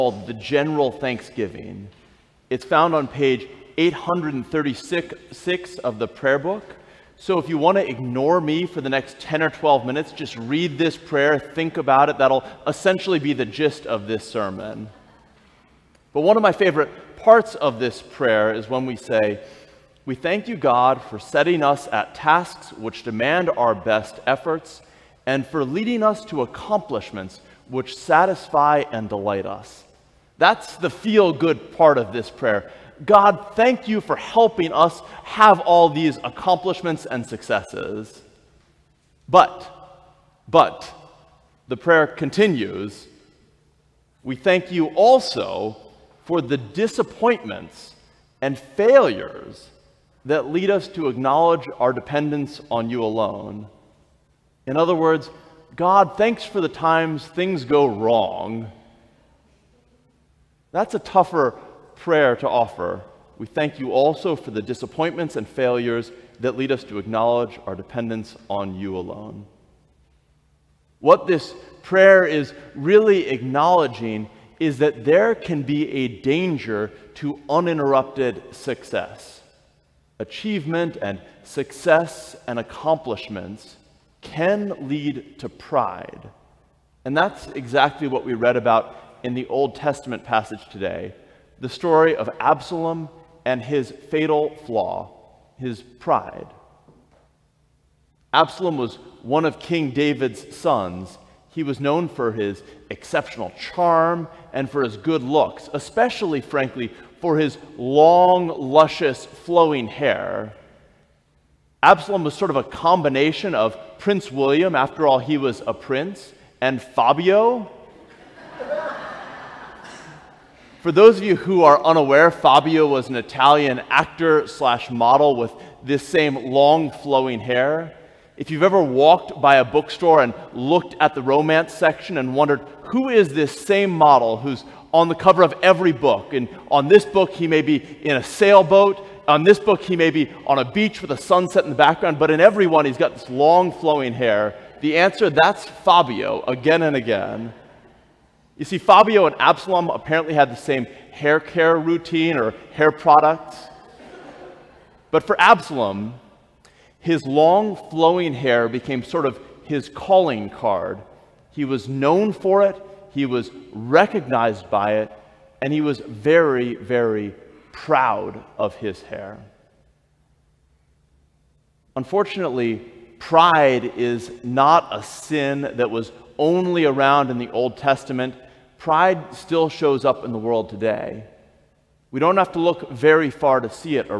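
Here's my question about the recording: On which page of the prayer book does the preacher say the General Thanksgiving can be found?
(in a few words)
836.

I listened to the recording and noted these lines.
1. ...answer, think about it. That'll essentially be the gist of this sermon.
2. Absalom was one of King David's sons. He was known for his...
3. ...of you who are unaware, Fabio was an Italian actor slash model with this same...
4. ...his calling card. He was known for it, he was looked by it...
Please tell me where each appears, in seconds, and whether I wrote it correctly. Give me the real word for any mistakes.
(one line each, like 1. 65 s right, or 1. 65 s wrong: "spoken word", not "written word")
1. 10 s wrong: "prayer", not "answer"
2. 98 s right
3. 121 s right
4. 159 s wrong: "recognized", not "looked".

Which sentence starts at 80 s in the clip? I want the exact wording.
Achievement and success and accomplishments can lead to pride.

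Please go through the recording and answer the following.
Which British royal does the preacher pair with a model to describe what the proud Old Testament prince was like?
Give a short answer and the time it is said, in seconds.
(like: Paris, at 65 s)
Prince William, at 113 s.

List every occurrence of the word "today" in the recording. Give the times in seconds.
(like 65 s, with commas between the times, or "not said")
90 s, 180 s.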